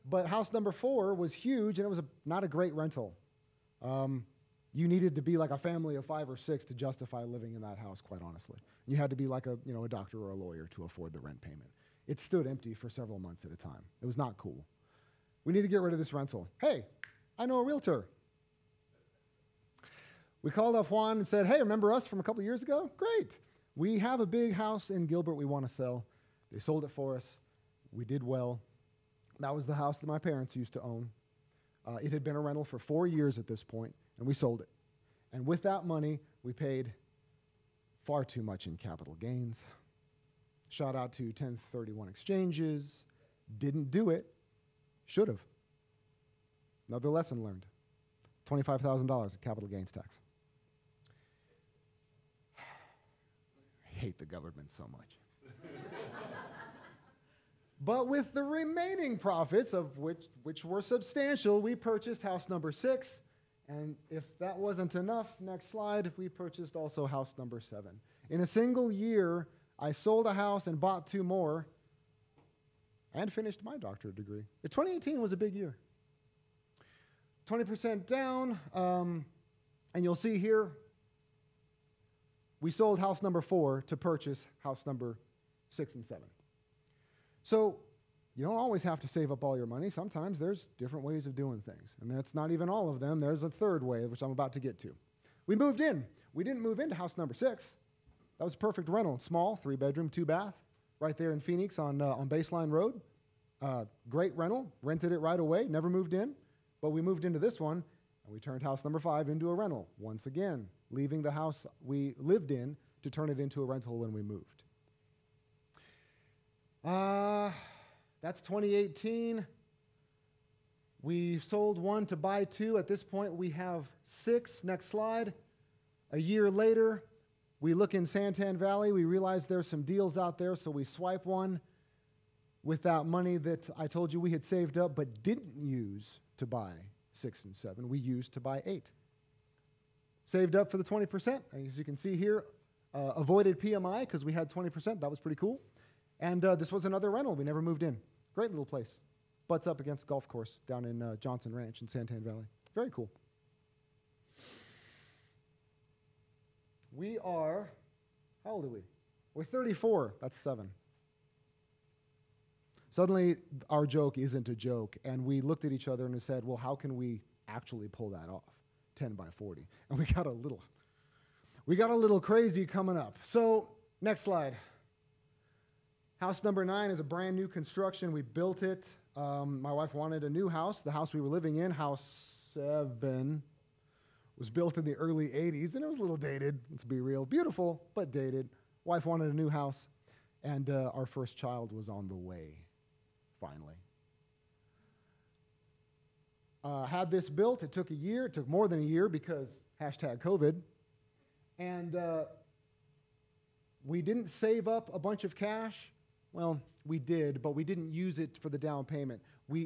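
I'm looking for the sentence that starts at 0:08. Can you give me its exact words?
You had to be like a, you know, a doctor or a lawyer to afford the rent payment.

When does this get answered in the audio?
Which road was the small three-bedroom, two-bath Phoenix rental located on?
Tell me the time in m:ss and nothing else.
1:42.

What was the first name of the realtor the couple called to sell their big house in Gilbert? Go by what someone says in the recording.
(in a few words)
Juan.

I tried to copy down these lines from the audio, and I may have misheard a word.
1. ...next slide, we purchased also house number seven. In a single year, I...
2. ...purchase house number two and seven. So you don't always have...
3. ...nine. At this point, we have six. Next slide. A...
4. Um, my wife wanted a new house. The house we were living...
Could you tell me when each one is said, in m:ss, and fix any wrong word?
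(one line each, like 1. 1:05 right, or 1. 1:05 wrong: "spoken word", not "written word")
1. 1:05 right
2. 1:23 wrong: "six", not "two"
3. 2:02 wrong: "two", not "nine"
4. 2:59 right.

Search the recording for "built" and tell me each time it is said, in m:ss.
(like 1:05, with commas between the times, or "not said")
2:58, 3:04, 3:17.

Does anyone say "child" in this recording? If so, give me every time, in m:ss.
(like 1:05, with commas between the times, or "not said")
3:11.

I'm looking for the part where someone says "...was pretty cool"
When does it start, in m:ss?
2:25.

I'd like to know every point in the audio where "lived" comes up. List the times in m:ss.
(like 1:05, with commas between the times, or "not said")
1:52.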